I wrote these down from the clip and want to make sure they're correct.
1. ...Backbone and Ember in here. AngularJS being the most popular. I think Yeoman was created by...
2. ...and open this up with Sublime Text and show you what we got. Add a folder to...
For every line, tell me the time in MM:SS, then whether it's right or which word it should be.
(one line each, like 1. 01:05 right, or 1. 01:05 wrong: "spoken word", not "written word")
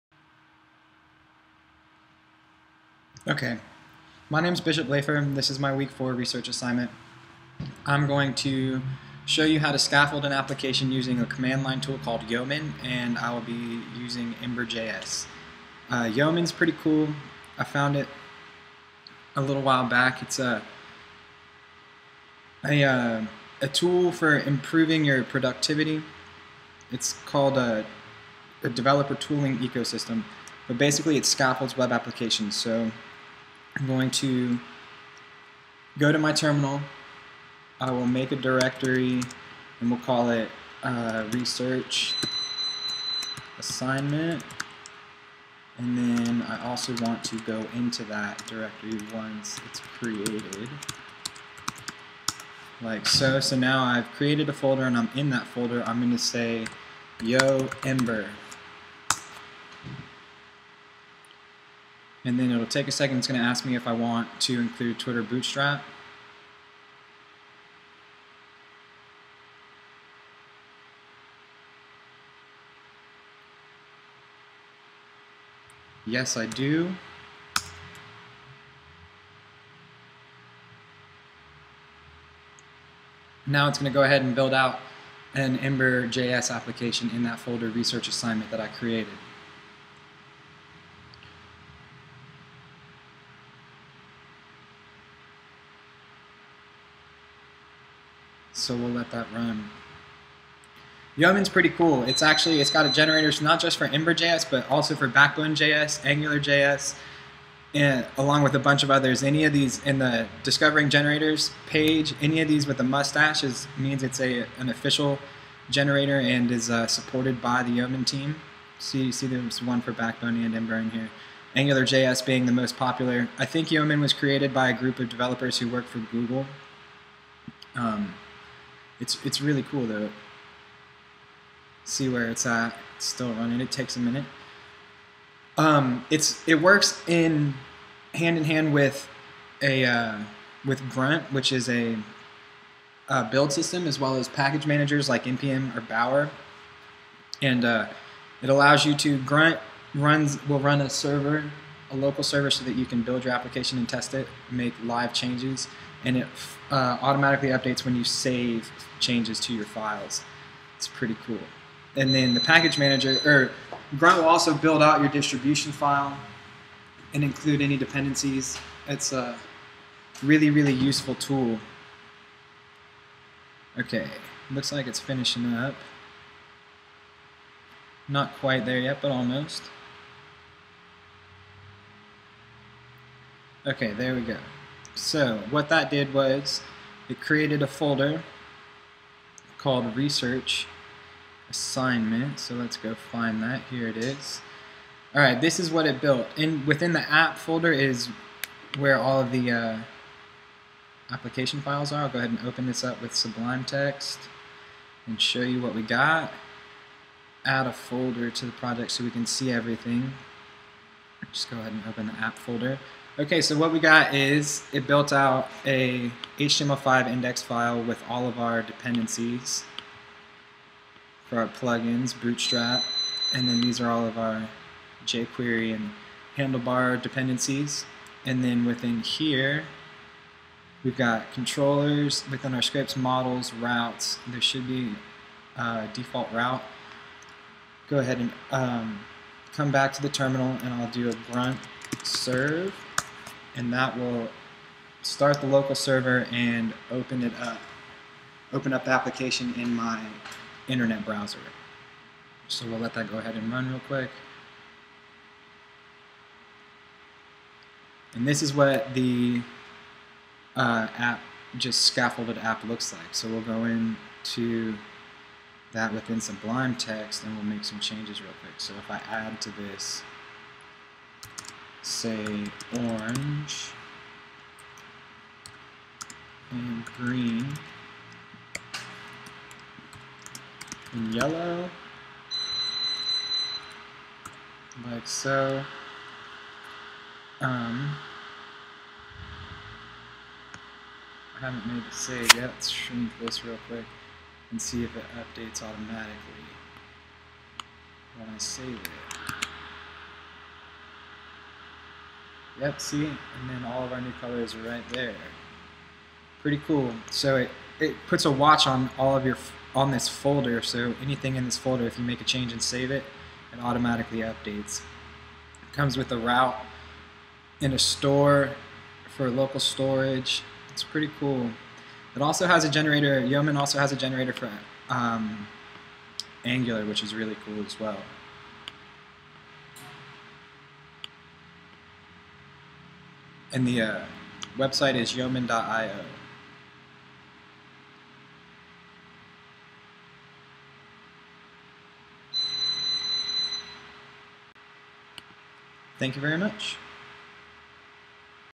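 1. 01:59 right
2. 03:22 right.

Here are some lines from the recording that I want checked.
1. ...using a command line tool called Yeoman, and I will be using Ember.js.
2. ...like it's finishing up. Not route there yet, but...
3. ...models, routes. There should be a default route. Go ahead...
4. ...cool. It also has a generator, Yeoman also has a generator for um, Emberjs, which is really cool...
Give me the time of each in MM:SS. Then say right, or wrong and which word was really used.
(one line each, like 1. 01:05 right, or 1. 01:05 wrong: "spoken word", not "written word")
1. 00:10 right
2. 02:54 wrong: "quite", not "route"
3. 03:52 right
4. 05:21 wrong: "Angular", not "Emberjs".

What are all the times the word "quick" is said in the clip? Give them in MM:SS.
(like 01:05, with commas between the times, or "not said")
04:13, 04:28, 04:53.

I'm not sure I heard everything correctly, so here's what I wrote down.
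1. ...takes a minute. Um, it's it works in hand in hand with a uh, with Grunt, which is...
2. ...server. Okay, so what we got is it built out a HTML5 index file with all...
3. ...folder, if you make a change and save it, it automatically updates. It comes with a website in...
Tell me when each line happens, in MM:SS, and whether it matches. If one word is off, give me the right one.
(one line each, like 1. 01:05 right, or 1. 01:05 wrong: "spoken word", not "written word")
1. 02:13 right
2. 03:32 wrong: "folder", not "server"
3. 05:11 wrong: "route", not "website".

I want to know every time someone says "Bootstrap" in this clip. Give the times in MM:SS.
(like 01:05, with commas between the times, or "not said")
01:05, 03:42.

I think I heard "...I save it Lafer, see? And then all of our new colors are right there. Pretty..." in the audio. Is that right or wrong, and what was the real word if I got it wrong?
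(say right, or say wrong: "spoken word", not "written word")
wrong: "Yep", not "Lafer".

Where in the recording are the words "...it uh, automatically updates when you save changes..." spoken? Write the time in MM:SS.
02:36.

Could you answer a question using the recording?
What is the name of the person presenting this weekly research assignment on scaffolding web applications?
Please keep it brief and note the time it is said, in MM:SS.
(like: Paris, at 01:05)
Bishop Lafer, at 00:04.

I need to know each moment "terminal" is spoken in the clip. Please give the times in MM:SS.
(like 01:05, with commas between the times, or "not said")
00:36, 04:00.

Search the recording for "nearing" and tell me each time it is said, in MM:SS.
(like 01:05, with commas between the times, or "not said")
not said.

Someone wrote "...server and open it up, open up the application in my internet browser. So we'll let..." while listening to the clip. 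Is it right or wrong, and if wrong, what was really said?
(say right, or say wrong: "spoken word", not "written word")
right.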